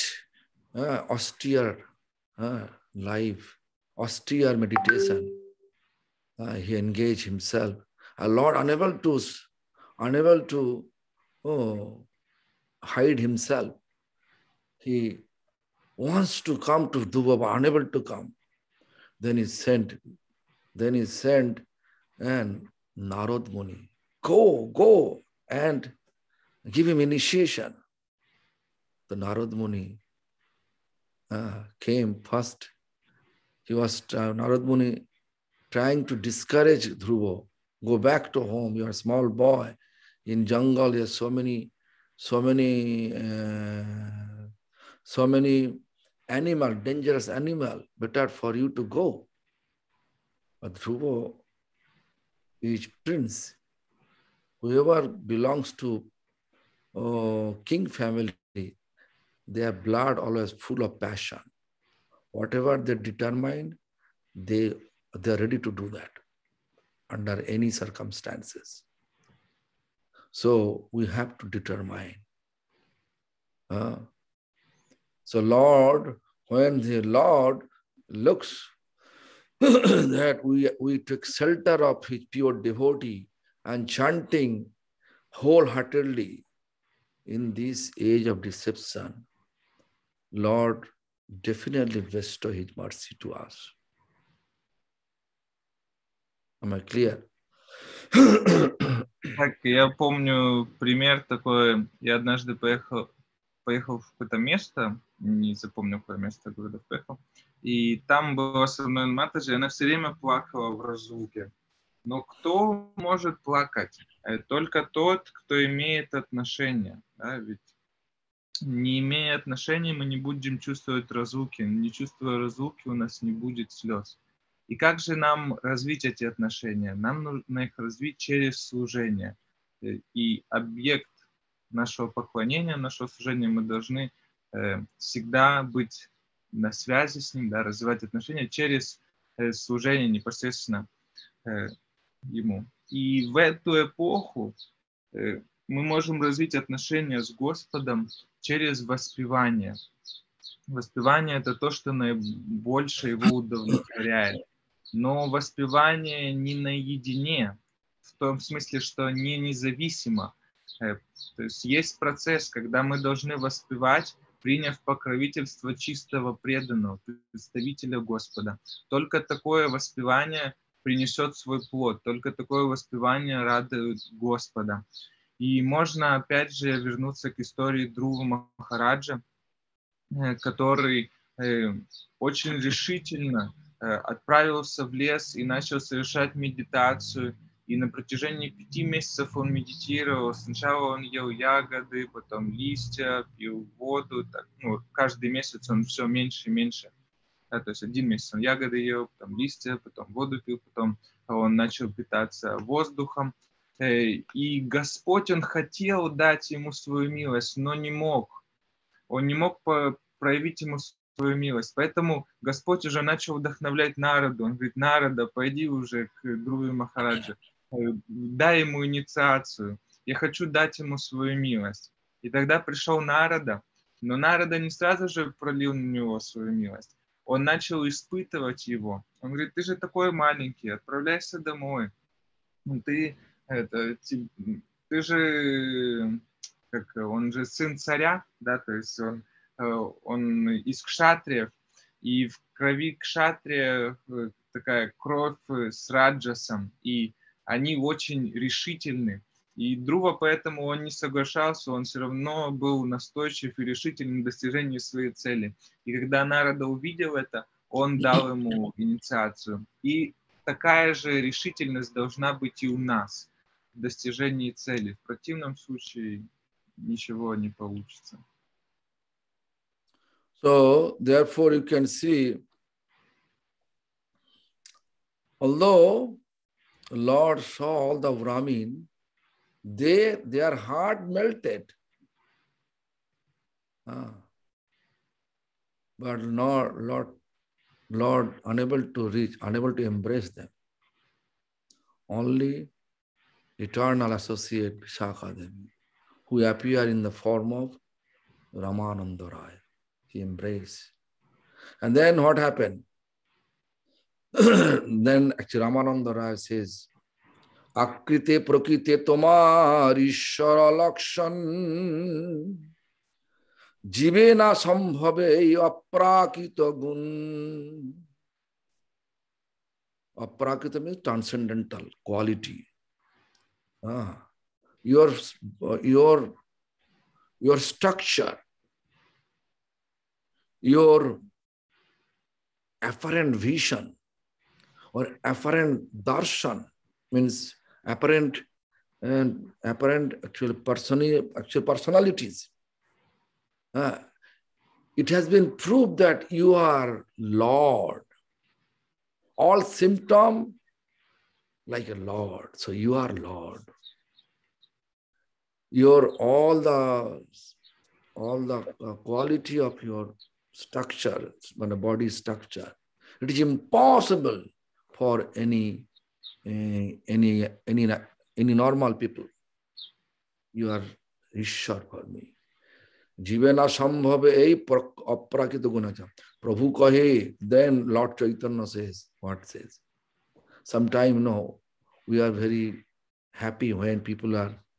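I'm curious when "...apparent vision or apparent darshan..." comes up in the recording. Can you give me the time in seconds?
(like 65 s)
332 s.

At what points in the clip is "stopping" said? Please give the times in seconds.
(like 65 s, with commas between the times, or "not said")
not said.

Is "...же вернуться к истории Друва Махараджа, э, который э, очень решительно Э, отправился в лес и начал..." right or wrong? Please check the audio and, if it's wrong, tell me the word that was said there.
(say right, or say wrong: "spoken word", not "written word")
right.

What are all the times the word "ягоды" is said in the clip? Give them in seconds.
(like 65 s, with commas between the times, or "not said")
191 s, 198 s.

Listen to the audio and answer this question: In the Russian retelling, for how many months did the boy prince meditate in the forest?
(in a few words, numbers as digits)
5.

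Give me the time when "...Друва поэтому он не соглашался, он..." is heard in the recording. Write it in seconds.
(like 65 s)
249 s.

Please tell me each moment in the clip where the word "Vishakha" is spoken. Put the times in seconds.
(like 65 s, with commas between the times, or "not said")
294 s.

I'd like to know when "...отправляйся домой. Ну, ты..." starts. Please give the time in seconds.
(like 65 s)
230 s.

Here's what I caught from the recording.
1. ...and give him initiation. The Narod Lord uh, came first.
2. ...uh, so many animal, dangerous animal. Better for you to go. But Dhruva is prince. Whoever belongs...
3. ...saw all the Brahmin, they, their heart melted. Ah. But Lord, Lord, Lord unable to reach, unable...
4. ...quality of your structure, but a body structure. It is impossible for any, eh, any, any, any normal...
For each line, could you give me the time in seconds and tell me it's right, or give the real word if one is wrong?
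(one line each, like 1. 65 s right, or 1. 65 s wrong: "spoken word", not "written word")
1. 25 s wrong: "Muni", not "Lord"
2. 43 s right
3. 277 s right
4. 358 s right.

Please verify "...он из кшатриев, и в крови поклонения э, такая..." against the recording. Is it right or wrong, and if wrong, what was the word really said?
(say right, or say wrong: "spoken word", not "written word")
wrong: "кшатрия", not "поклонения".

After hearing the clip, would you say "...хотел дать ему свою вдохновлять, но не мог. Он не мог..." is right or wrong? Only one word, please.
wrong.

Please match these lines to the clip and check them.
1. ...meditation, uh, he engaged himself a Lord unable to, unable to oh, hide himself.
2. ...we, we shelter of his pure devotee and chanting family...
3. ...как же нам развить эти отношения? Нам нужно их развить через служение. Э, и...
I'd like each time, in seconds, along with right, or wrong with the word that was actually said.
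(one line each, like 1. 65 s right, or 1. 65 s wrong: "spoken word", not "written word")
1. 4 s right
2. 80 s wrong: "wholeheartedly", not "family"
3. 124 s right.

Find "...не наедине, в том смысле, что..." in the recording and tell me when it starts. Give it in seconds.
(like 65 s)
156 s.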